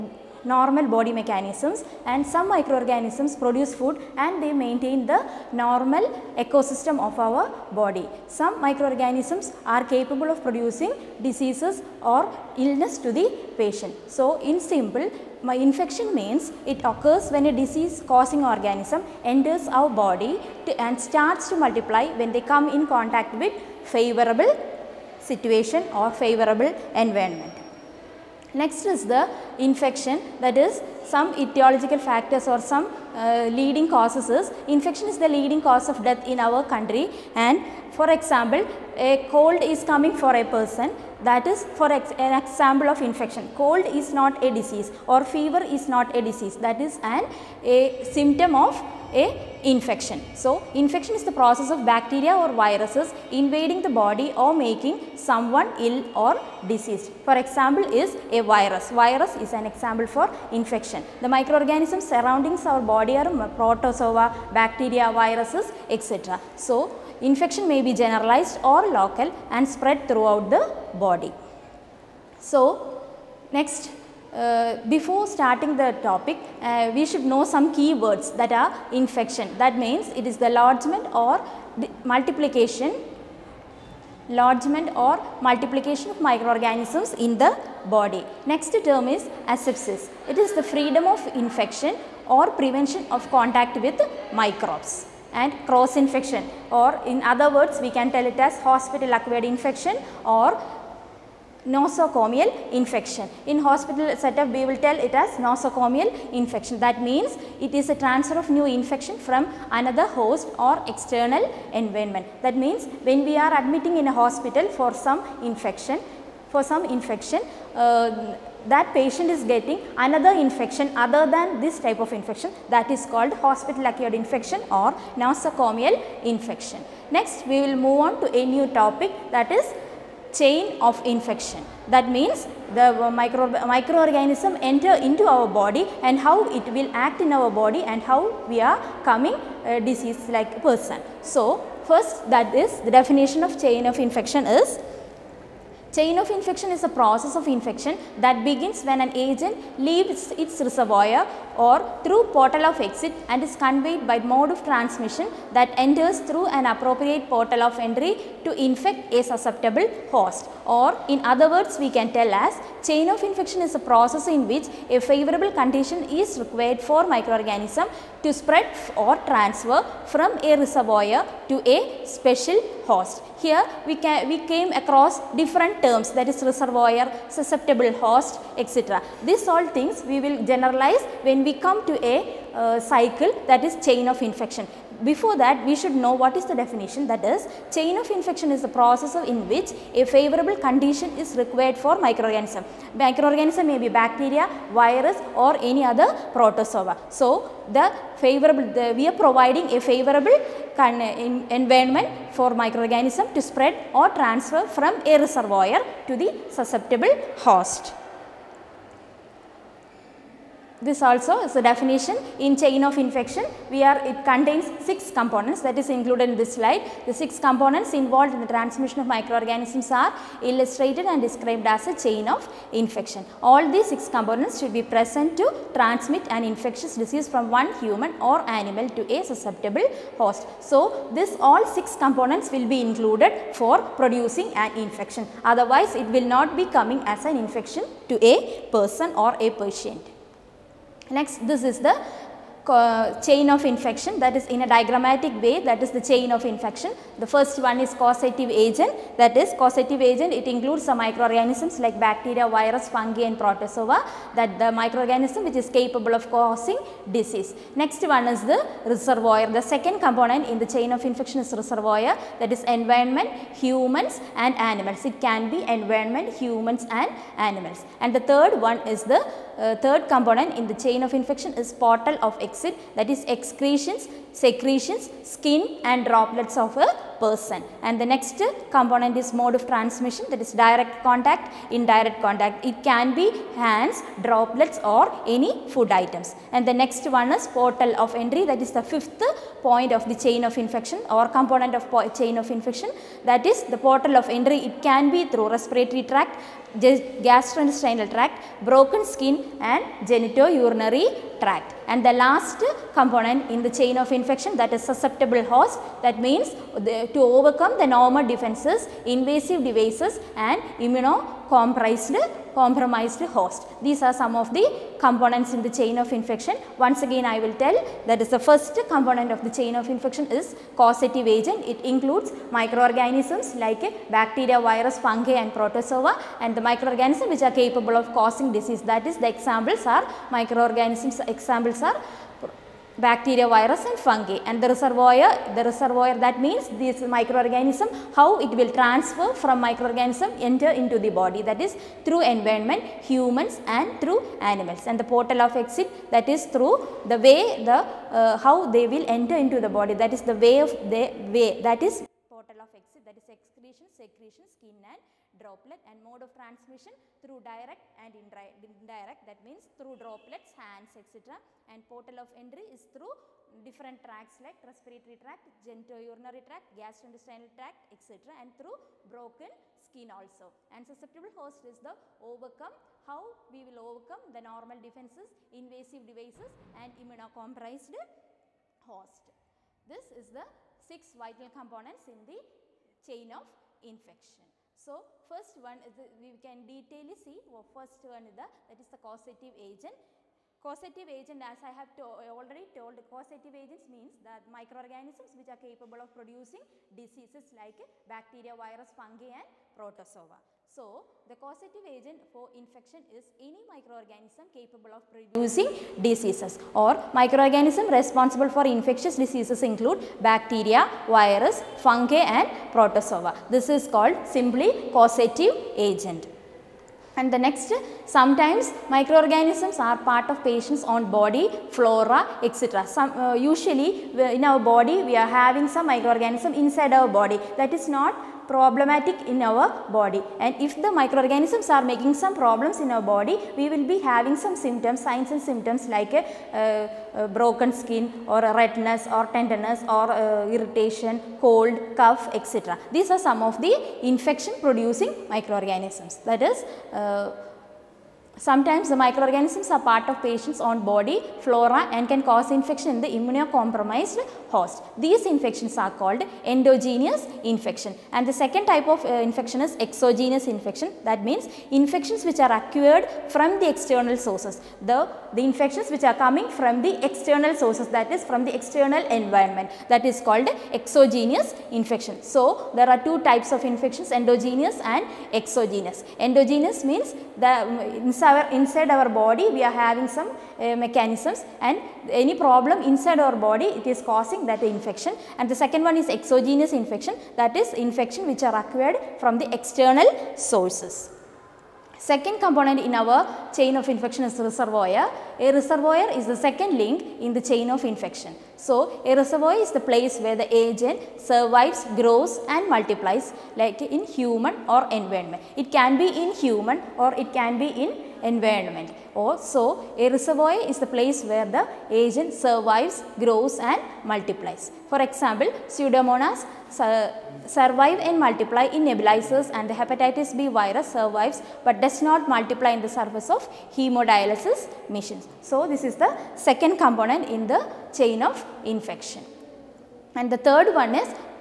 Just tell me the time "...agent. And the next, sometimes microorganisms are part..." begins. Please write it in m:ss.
6:55.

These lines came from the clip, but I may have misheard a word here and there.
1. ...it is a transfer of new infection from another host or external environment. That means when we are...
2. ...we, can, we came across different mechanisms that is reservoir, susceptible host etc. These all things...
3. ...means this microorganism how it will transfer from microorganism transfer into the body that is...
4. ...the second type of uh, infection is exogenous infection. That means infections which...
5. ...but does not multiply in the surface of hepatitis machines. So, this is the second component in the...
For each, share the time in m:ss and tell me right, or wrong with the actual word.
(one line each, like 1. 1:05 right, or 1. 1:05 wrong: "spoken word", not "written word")
1. 1:47 right
2. 2:53 wrong: "terms", not "mechanisms"
3. 5:36 wrong: "enter", not "transfer"
4. 7:38 right
5. 8:41 wrong: "hemodialysis", not "hepatitis".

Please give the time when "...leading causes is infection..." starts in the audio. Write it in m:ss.
0:33.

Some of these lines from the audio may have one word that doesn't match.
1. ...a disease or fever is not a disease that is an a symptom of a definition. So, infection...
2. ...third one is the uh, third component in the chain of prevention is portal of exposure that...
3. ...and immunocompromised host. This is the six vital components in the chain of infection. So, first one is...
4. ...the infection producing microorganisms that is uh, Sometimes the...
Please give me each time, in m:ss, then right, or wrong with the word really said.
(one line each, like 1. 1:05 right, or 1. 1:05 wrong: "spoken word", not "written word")
1. 0:44 wrong: "infection", not "definition"
2. 4:28 wrong: "infection", not "prevention"
3. 6:16 right
4. 7:23 right.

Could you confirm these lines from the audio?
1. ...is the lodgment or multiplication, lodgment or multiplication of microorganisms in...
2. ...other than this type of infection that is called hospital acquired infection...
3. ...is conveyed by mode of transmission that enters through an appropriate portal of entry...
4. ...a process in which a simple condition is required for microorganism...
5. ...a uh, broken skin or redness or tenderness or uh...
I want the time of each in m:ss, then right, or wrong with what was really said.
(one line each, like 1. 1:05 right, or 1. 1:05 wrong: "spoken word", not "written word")
1. 1:20 right
2. 2:00 right
3. 2:33 right
4. 2:43 wrong: "favorable", not "simple"
5. 7:16 right.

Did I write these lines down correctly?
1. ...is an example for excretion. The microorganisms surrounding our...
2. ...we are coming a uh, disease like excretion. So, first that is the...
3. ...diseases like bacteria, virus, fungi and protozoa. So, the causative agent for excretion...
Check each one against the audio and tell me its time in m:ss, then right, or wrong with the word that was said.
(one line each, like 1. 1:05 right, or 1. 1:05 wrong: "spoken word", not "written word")
1. 0:59 wrong: "infection", not "excretion"
2. 2:18 wrong: "person", not "excretion"
3. 6:36 wrong: "infection", not "excretion".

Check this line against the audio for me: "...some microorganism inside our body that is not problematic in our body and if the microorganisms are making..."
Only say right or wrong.
right.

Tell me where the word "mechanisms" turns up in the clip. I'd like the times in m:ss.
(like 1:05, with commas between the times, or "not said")
0:01, 8:00.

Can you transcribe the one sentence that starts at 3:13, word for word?
Microorganism may be bacteria, virus or any other protozoa.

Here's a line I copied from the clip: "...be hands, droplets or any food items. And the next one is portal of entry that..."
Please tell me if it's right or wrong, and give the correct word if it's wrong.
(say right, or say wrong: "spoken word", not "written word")
right.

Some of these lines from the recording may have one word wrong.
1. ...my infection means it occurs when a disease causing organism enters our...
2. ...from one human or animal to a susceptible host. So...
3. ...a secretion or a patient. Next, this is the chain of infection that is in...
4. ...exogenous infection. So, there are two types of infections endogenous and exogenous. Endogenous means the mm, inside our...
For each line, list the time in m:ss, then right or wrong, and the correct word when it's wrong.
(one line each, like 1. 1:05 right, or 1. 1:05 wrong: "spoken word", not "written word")
1. 0:15 right
2. 3:47 right
3. 3:58 wrong: "person", not "secretion"
4. 7:50 right.